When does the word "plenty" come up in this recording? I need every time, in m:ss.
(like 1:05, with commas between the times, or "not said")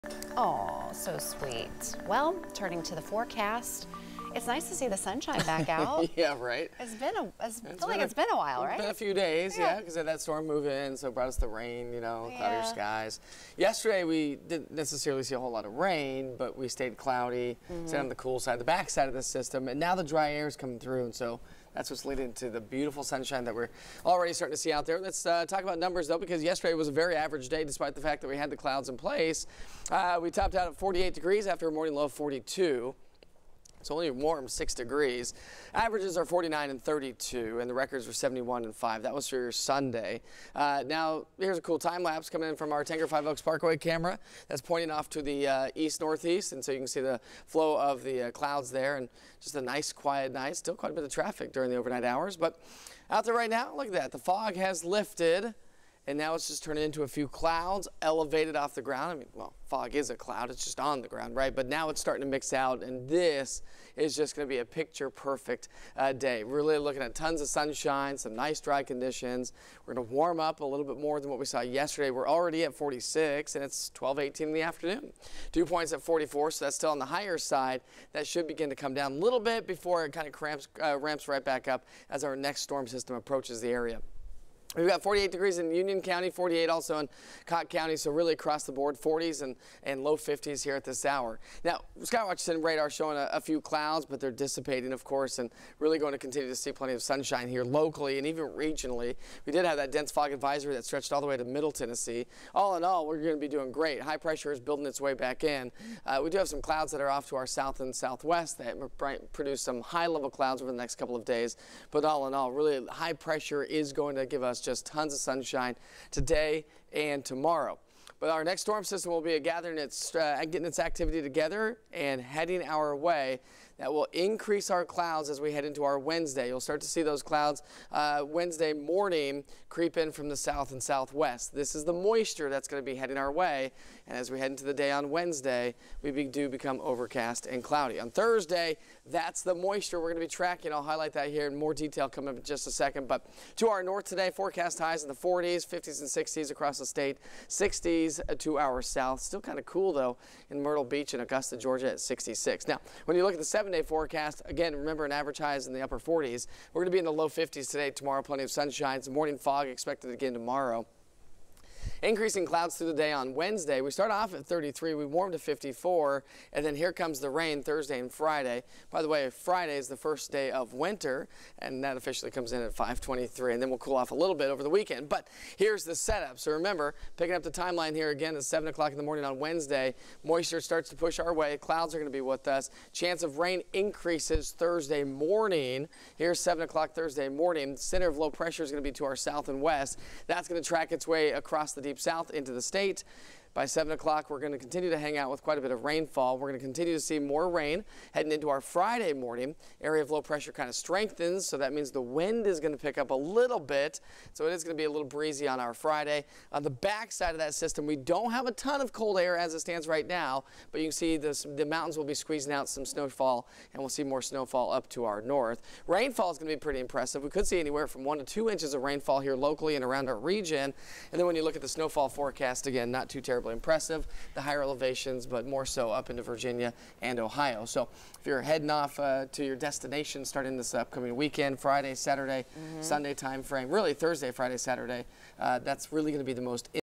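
1:36, 2:38.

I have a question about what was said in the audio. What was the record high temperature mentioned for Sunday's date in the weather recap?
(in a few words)
71.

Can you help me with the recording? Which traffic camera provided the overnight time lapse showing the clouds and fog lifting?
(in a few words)
Tanger Five Oaks Parkway.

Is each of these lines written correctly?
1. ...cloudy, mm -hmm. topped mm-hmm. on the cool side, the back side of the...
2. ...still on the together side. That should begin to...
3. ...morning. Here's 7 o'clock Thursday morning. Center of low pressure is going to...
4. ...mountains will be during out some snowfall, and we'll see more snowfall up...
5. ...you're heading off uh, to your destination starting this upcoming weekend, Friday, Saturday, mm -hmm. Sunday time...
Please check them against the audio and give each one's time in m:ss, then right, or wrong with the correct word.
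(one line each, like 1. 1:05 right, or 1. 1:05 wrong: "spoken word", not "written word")
1. 0:16 wrong: "stayed", not "topped"
2. 1:16 wrong: "higher", not "together"
3. 3:05 right
4. 3:31 wrong: "squeezing", not "during"
5. 3:48 right.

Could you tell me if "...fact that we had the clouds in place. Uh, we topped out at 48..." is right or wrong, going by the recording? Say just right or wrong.
right.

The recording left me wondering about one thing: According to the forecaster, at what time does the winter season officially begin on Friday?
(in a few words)
5:23.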